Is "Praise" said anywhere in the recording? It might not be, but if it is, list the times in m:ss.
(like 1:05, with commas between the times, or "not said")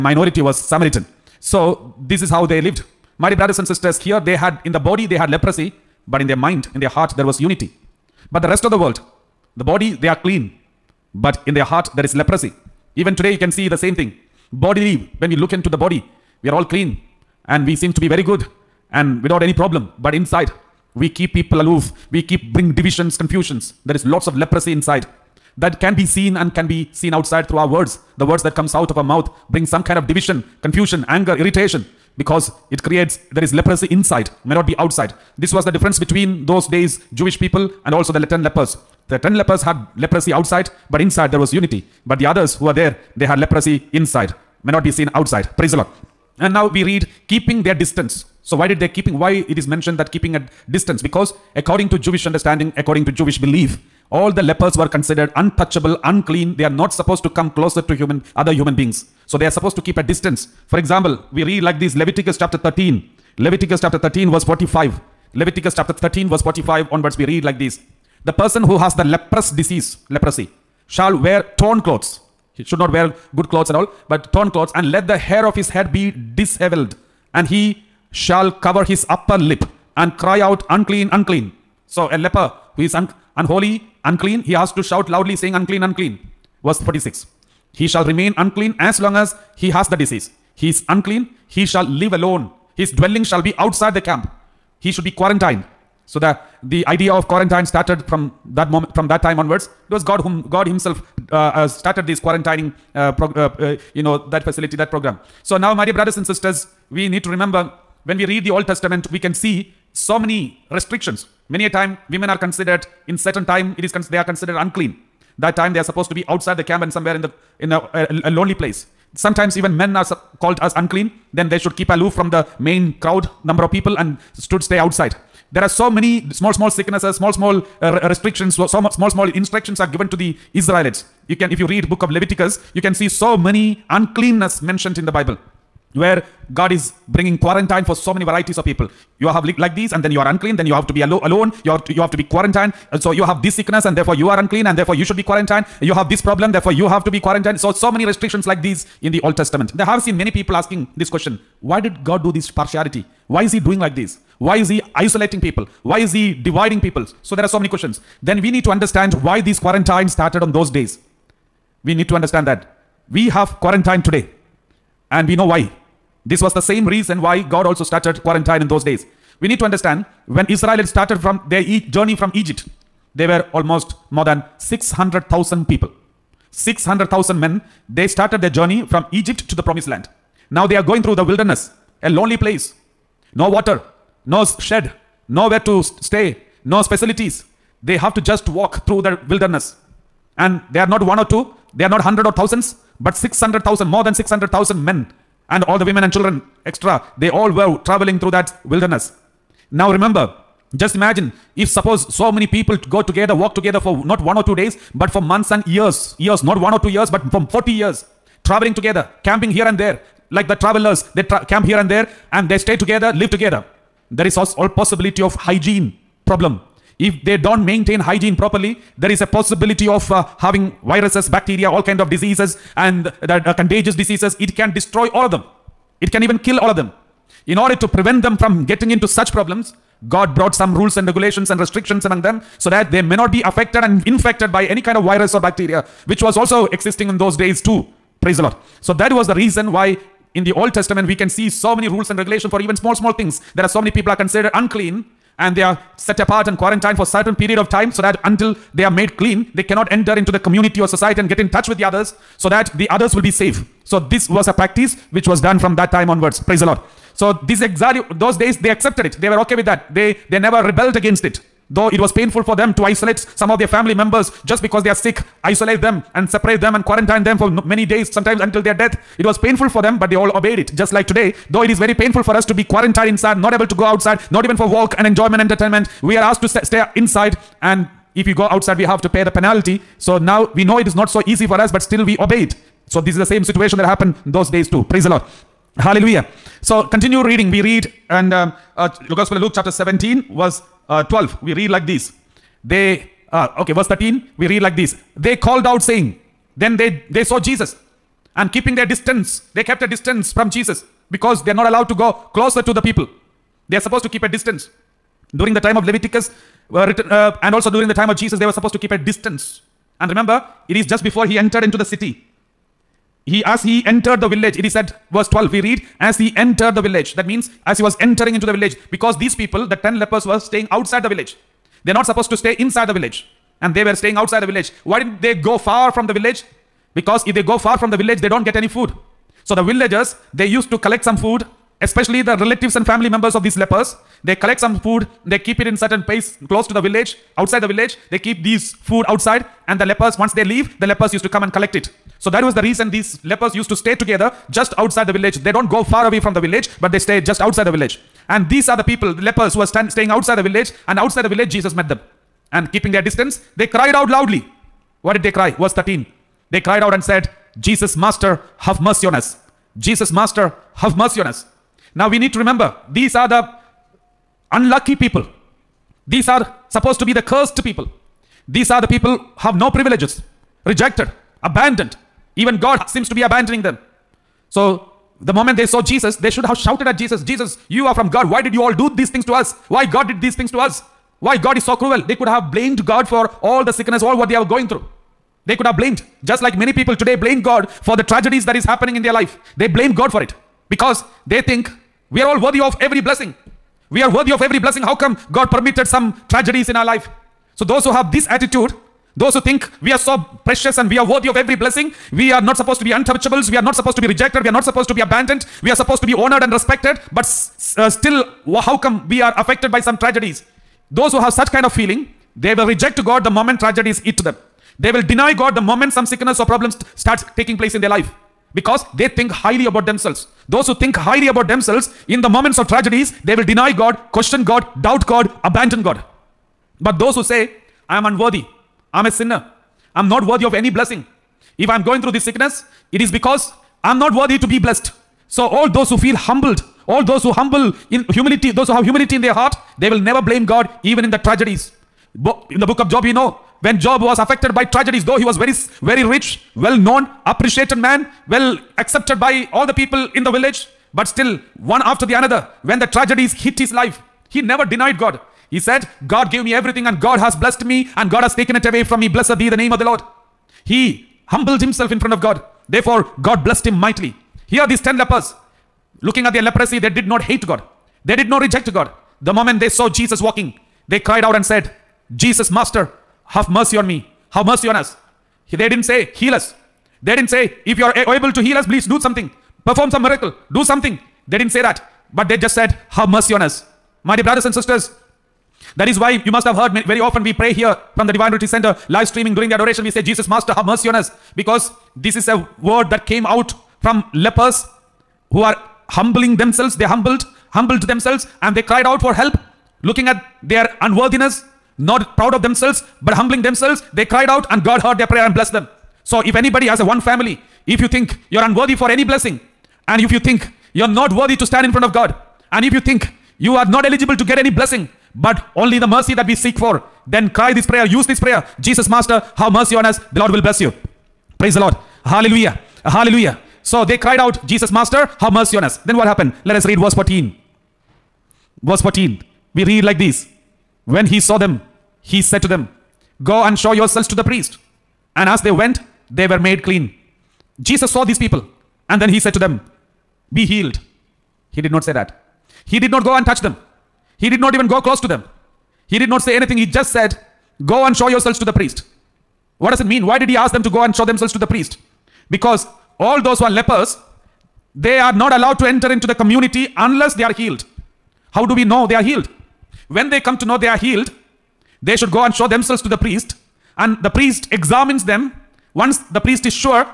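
0:45, 3:58, 4:16, 4:44, 8:41.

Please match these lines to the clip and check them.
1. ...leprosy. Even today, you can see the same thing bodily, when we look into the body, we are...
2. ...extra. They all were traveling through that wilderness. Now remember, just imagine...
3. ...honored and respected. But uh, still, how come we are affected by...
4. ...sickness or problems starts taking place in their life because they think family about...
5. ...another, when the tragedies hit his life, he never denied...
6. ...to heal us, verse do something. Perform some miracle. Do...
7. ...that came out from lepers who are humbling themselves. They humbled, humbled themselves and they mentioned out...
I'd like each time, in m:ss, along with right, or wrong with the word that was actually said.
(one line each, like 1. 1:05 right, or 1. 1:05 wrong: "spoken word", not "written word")
1. 0:12 right
2. 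3:16 right
3. 6:46 right
4. 6:56 wrong: "highly", not "family"
5. 7:32 right
6. 7:58 wrong: "please", not "verse"
7. 8:12 wrong: "cried", not "mentioned".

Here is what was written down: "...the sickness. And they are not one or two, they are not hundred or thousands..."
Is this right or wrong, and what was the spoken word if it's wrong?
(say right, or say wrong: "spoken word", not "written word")
wrong: "wilderness", not "sickness".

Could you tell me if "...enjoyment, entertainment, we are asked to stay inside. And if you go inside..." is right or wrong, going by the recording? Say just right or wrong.
wrong.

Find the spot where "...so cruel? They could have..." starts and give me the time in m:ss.
6:21.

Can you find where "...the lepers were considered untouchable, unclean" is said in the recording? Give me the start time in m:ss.
0:54.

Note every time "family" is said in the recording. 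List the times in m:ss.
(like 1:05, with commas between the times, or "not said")
4:23, 5:32, 8:27.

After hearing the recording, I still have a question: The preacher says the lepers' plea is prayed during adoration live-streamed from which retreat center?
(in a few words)
Divine Retreat Center.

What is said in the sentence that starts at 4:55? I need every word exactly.
They called out saying, then they, they saw Jesus and keeping their distance.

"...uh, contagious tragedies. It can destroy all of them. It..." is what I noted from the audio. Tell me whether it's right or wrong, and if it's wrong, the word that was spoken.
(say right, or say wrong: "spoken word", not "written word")
wrong: "diseases", not "tragedies".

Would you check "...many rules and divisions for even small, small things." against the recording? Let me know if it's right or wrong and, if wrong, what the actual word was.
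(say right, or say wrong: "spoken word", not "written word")
wrong: "regulations", not "divisions".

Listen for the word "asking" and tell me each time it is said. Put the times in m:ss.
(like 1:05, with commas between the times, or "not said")
2:30.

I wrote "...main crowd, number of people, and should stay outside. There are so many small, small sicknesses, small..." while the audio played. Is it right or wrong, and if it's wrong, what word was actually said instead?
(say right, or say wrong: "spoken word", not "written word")
right.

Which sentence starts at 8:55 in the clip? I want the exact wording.
And as they went, they were made clean.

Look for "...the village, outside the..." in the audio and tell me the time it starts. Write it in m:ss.
5:36.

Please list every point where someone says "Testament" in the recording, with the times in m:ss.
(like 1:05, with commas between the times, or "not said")
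1:48, 2:29, 4:00.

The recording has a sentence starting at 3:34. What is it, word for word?
There is also possibility of hygiene problem.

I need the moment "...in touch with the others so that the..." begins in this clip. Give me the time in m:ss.
4:11.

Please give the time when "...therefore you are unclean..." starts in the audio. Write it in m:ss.
2:23.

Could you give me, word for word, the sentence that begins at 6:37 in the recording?
So those who have this attitude, those who think we are so precious and we are worthy of every blessing.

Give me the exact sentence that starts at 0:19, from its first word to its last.
But inside, we keep people aloof.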